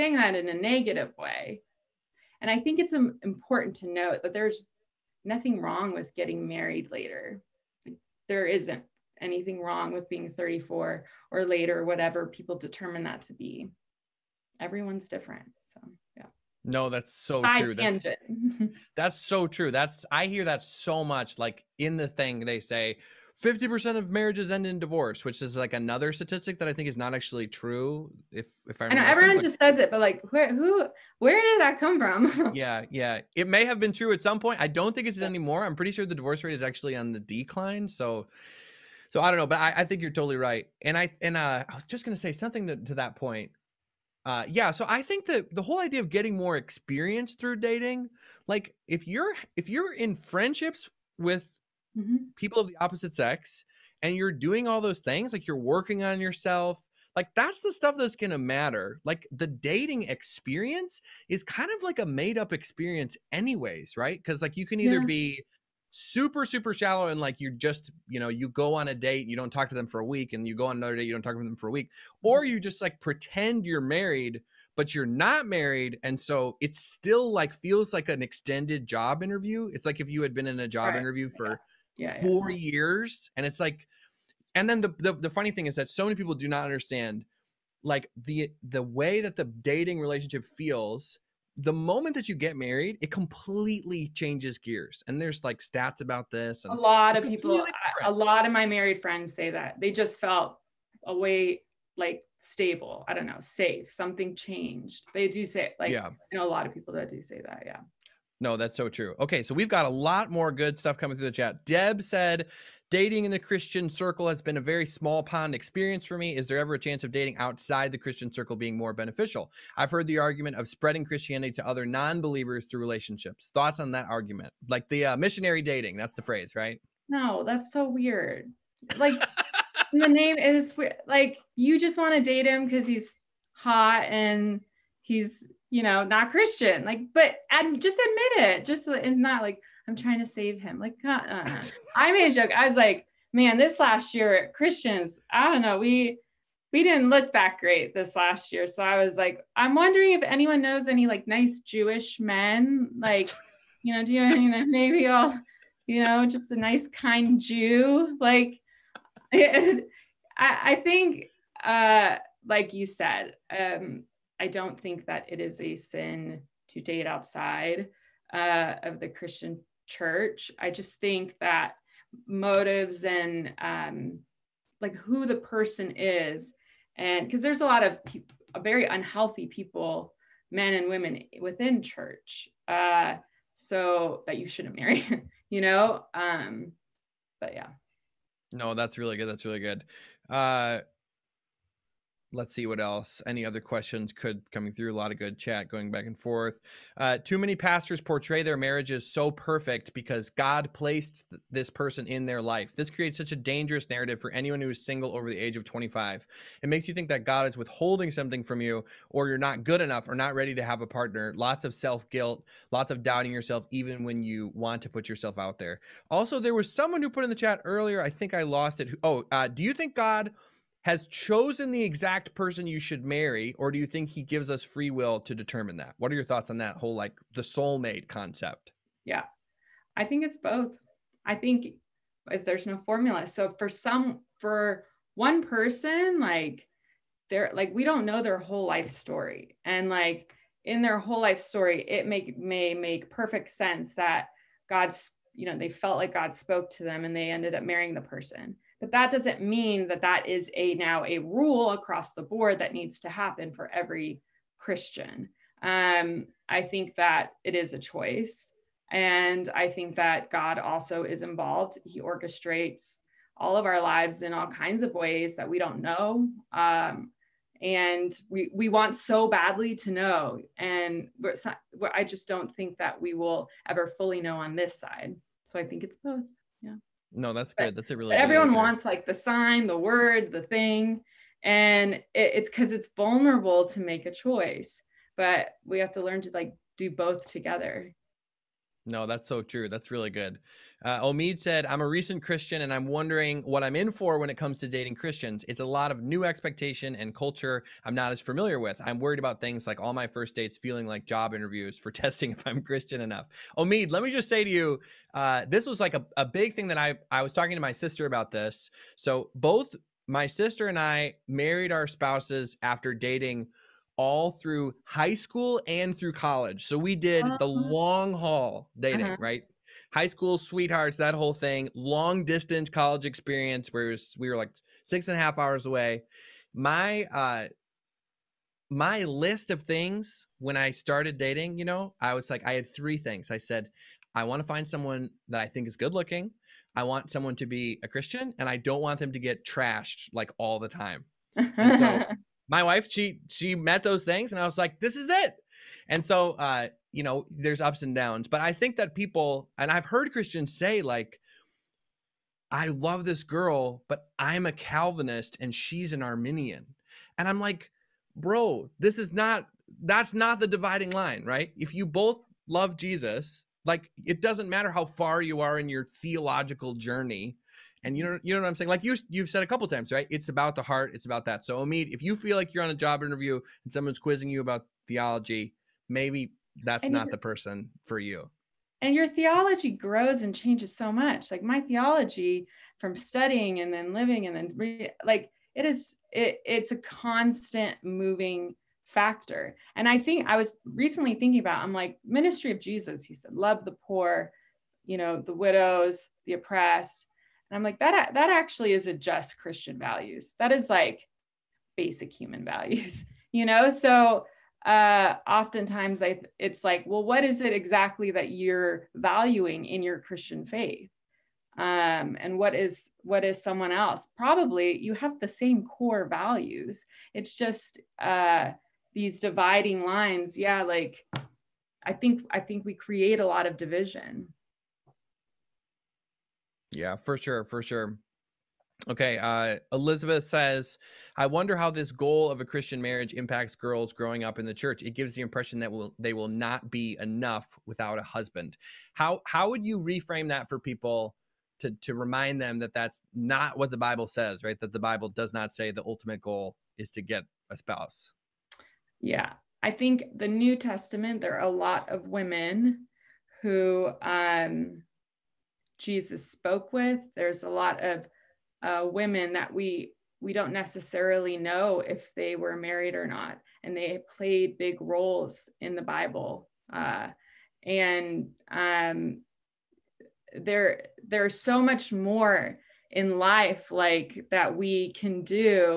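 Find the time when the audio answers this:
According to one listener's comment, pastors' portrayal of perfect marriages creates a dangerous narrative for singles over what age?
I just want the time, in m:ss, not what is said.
3:25.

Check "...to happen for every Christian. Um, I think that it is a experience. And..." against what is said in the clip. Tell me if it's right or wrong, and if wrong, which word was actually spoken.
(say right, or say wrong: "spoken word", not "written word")
wrong: "choice", not "experience".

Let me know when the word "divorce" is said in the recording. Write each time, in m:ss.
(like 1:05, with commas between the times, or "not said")
0:24, 0:36.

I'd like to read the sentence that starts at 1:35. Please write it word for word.
And there's like stats about this.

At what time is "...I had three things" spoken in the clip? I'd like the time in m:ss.
5:32.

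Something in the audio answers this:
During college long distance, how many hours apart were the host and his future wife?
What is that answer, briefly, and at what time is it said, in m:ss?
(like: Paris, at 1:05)
6.5 hours, at 5:24.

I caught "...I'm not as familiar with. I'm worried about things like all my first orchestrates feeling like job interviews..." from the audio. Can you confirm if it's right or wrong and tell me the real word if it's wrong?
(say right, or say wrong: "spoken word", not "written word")
wrong: "dates", not "orchestrates".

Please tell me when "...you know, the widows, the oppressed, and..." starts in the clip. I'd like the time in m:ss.
6:34.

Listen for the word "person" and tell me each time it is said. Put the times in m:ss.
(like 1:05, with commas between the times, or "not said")
2:55, 3:21, 3:42, 3:55, 4:08, 6:17.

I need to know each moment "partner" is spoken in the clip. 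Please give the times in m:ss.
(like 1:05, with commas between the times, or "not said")
3:30.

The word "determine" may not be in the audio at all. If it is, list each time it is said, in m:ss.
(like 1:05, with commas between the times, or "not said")
0:12, 3:45.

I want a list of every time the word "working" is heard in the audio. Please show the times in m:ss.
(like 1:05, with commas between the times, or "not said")
0:55.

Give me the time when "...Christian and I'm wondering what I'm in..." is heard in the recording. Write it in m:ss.
4:52.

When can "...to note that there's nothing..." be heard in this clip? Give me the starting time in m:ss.
0:03.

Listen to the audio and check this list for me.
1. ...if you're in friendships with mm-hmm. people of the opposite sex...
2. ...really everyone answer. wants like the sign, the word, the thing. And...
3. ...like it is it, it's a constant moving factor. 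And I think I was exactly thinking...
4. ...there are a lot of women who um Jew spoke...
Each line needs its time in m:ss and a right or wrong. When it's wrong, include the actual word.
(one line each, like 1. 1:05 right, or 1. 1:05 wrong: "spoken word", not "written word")
1. 0:49 right
2. 4:37 right
3. 6:25 wrong: "recently", not "exactly"
4. 7:31 wrong: "Jesus", not "Jew".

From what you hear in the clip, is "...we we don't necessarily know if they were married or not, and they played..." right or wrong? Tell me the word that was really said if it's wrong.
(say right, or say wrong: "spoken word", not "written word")
right.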